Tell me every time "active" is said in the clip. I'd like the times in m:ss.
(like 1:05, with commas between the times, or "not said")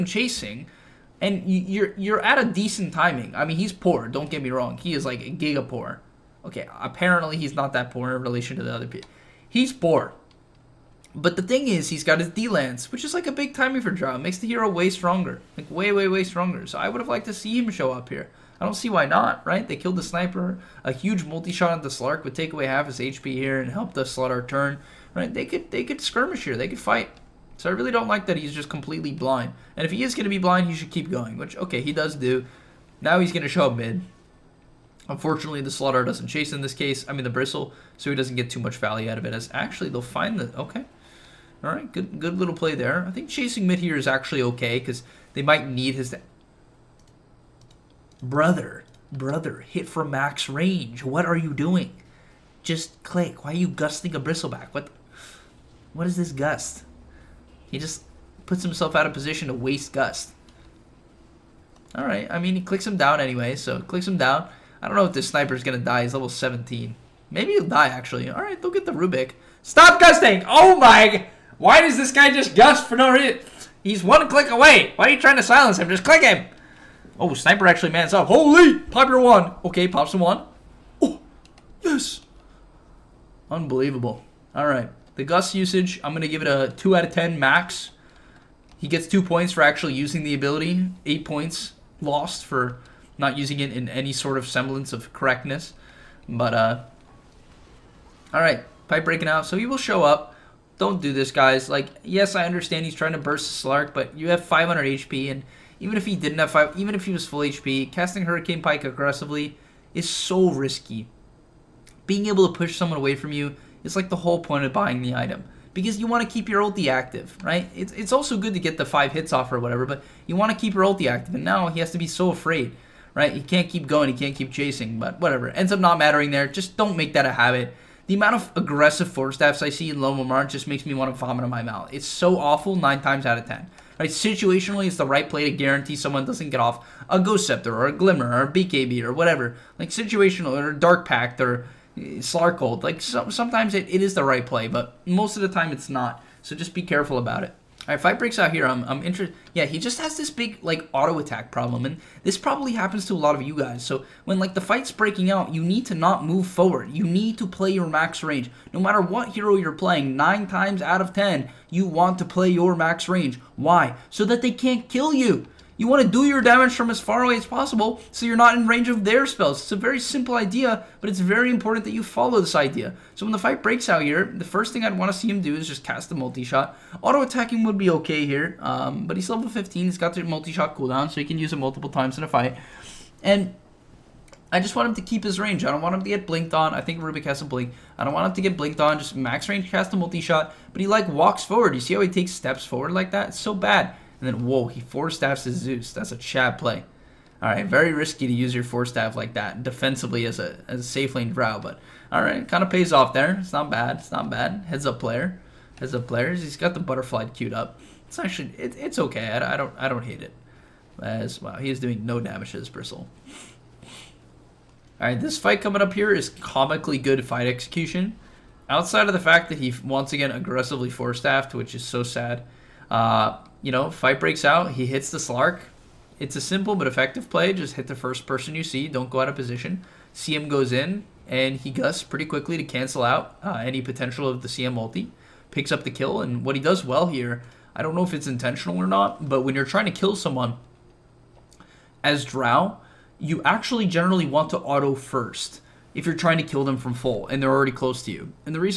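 1:56, 2:01.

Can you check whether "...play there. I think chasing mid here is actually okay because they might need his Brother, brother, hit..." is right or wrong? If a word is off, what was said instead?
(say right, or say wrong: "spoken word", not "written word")
right.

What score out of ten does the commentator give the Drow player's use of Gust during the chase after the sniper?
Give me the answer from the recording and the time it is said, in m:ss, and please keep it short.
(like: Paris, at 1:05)
2, at 1:26.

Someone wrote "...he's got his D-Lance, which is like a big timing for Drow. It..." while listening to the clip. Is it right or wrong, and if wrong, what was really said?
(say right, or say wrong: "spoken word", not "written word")
right.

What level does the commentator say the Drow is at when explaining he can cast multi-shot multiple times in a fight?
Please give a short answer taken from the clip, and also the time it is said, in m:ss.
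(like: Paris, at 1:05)
15, at 2:59.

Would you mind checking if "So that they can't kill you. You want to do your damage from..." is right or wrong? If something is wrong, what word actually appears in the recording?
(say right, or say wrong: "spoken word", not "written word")
right.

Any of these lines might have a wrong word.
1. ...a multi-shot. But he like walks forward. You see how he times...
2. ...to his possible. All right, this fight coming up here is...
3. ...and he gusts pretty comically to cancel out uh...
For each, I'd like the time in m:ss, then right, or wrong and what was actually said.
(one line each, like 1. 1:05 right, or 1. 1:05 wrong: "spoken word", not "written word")
1. 3:09 wrong: "takes", not "times"
2. 3:32 wrong: "bristle", not "possible"
3. 3:51 wrong: "quickly", not "comically".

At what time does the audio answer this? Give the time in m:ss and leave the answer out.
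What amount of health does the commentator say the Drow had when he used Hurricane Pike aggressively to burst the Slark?
1:44.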